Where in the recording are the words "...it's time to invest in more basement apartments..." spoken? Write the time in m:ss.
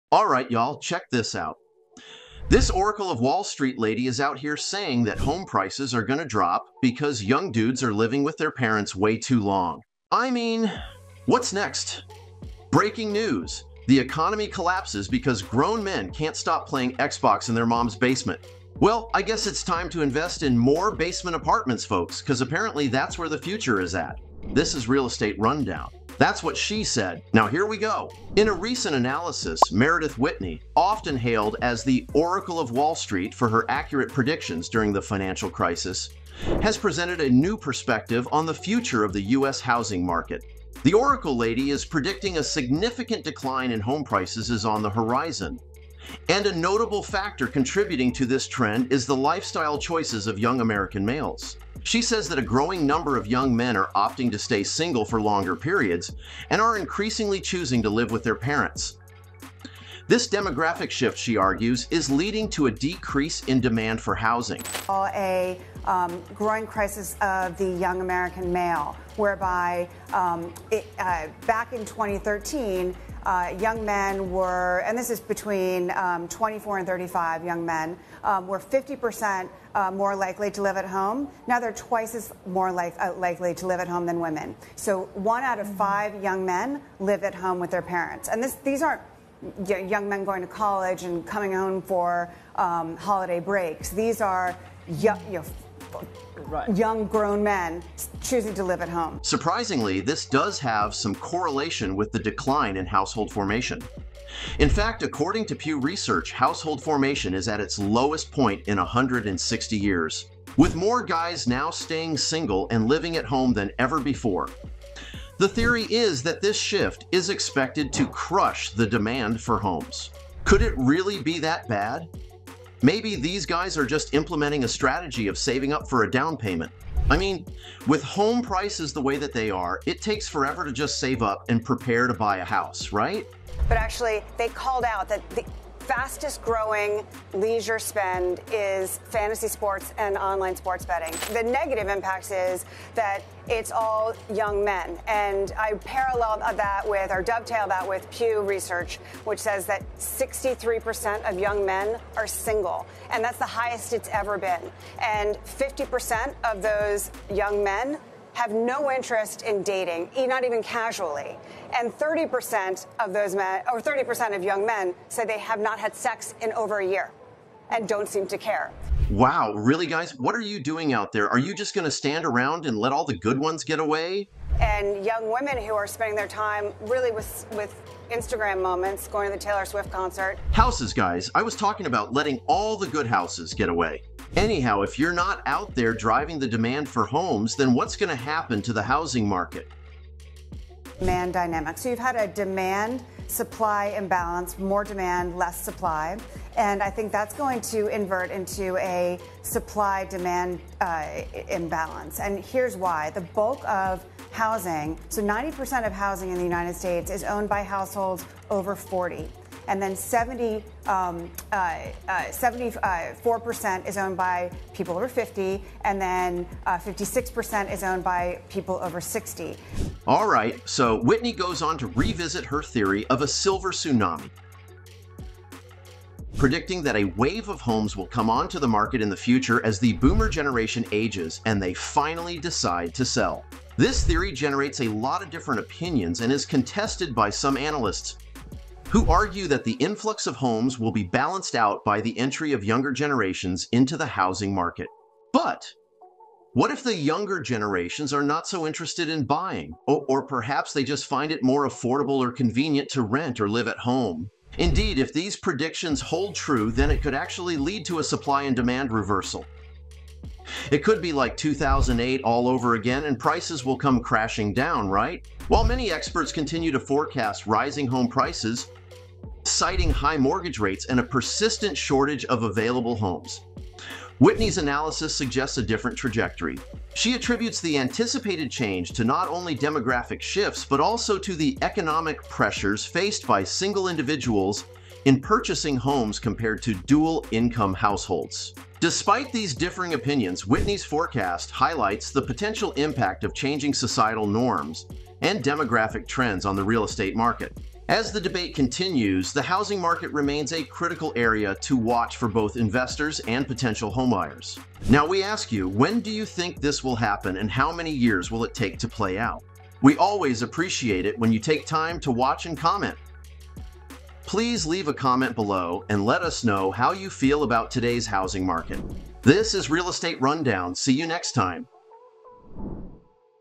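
0:19.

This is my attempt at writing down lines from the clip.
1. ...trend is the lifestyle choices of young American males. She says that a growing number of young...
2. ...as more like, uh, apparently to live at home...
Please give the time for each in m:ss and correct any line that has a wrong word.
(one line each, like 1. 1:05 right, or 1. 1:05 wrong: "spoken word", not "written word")
1. 0:48 right
2. 1:22 wrong: "likely", not "apparently".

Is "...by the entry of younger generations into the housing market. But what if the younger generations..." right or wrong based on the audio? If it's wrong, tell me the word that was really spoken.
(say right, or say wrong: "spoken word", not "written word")
right.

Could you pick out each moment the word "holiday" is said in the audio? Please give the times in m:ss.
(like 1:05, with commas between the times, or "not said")
1:32.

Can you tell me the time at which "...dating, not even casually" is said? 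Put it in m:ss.
2:39.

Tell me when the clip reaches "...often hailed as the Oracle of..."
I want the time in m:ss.
0:30.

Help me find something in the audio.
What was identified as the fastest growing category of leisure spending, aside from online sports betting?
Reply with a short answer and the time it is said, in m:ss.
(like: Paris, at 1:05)
Fantasy sports, at 2:19.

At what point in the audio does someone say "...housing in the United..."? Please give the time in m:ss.
3:25.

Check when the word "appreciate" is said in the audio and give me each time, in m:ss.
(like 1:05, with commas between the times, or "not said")
5:10.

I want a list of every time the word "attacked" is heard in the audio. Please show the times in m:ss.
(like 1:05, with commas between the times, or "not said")
not said.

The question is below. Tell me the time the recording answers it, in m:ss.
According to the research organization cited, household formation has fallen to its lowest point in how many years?
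1:48.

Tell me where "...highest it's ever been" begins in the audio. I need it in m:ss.
2:33.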